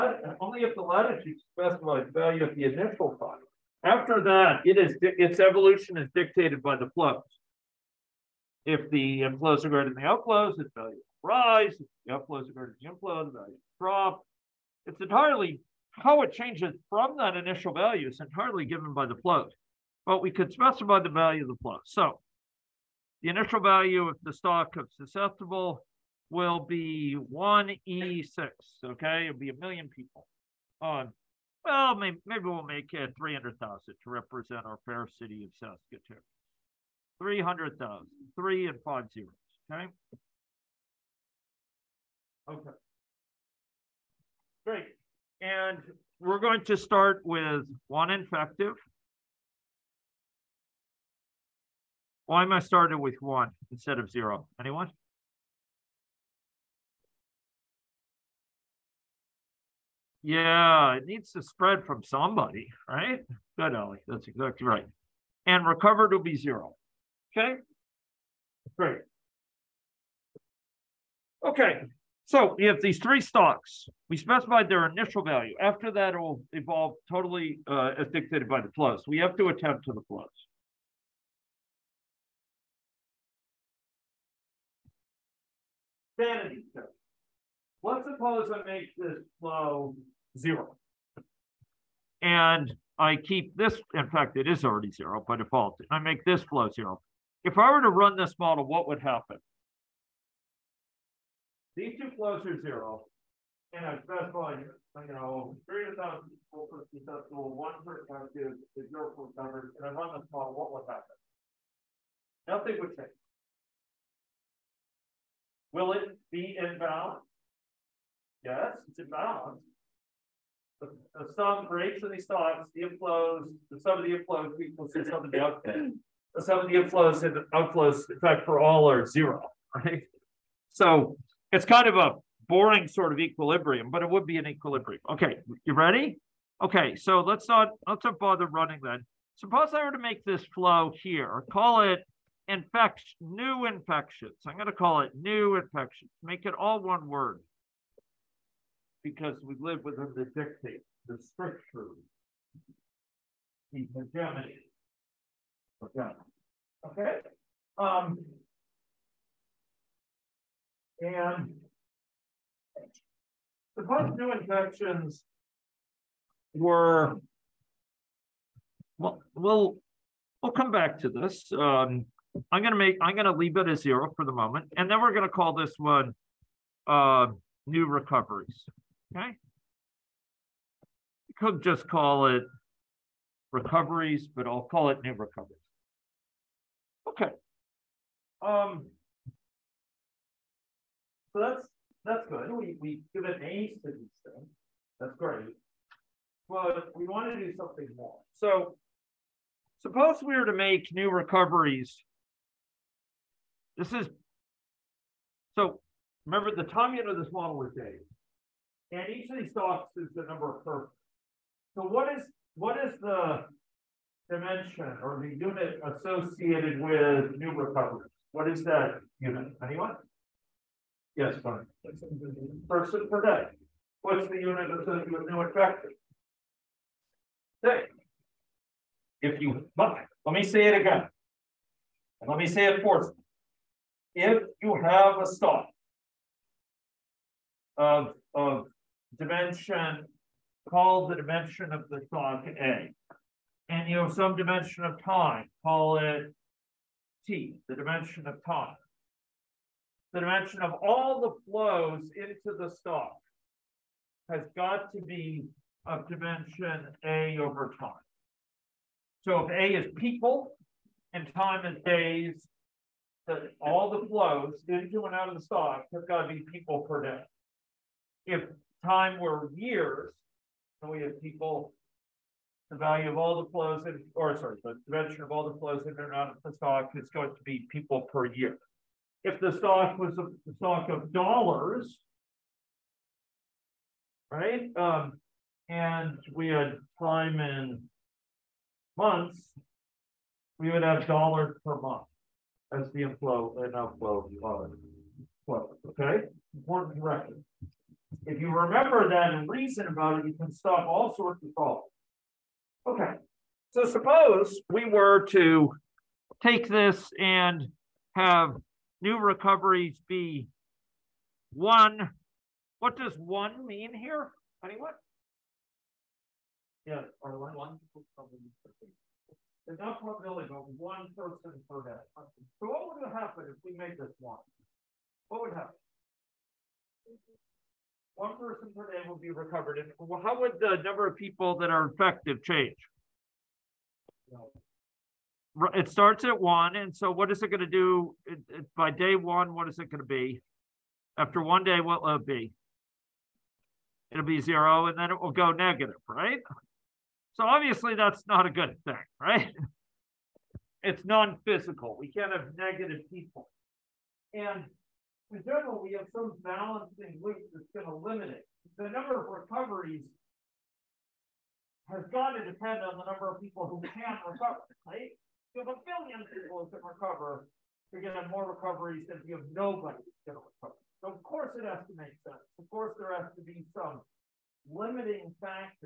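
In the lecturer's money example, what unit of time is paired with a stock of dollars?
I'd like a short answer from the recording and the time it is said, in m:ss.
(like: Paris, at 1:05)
months, at 4:48.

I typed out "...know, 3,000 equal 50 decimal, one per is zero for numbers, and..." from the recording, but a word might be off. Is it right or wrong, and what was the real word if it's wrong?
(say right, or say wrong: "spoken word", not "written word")
right.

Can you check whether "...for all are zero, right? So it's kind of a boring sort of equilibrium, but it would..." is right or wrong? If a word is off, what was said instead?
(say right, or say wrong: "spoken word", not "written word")
right.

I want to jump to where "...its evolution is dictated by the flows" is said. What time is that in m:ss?
0:05.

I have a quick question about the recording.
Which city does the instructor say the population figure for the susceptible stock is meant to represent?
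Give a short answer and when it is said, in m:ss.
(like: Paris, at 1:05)
Saskatoon, at 0:35.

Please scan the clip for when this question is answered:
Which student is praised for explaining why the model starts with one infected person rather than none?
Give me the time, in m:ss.
1:03.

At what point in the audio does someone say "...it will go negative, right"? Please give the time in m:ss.
5:45.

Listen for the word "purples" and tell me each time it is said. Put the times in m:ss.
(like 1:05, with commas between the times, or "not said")
3:30.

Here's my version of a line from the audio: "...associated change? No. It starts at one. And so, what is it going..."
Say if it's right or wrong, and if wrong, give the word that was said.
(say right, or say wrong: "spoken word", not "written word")
wrong: "infected", not "associated".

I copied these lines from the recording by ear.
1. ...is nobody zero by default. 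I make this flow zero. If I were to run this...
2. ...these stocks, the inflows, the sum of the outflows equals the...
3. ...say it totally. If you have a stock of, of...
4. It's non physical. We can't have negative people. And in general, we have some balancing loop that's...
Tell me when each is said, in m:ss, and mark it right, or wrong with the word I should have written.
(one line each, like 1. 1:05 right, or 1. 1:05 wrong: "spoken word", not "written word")
1. 1:34 wrong: "already", not "nobody"
2. 2:02 wrong: "inflows", not "outflows"
3. 3:52 wrong: "forcefully", not "totally"
4. 5:50 right.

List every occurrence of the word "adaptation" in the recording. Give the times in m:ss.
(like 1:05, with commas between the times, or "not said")
not said.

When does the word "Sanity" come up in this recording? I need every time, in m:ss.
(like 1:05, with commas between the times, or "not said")
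1:26.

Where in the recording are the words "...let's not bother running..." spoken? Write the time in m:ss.
2:17.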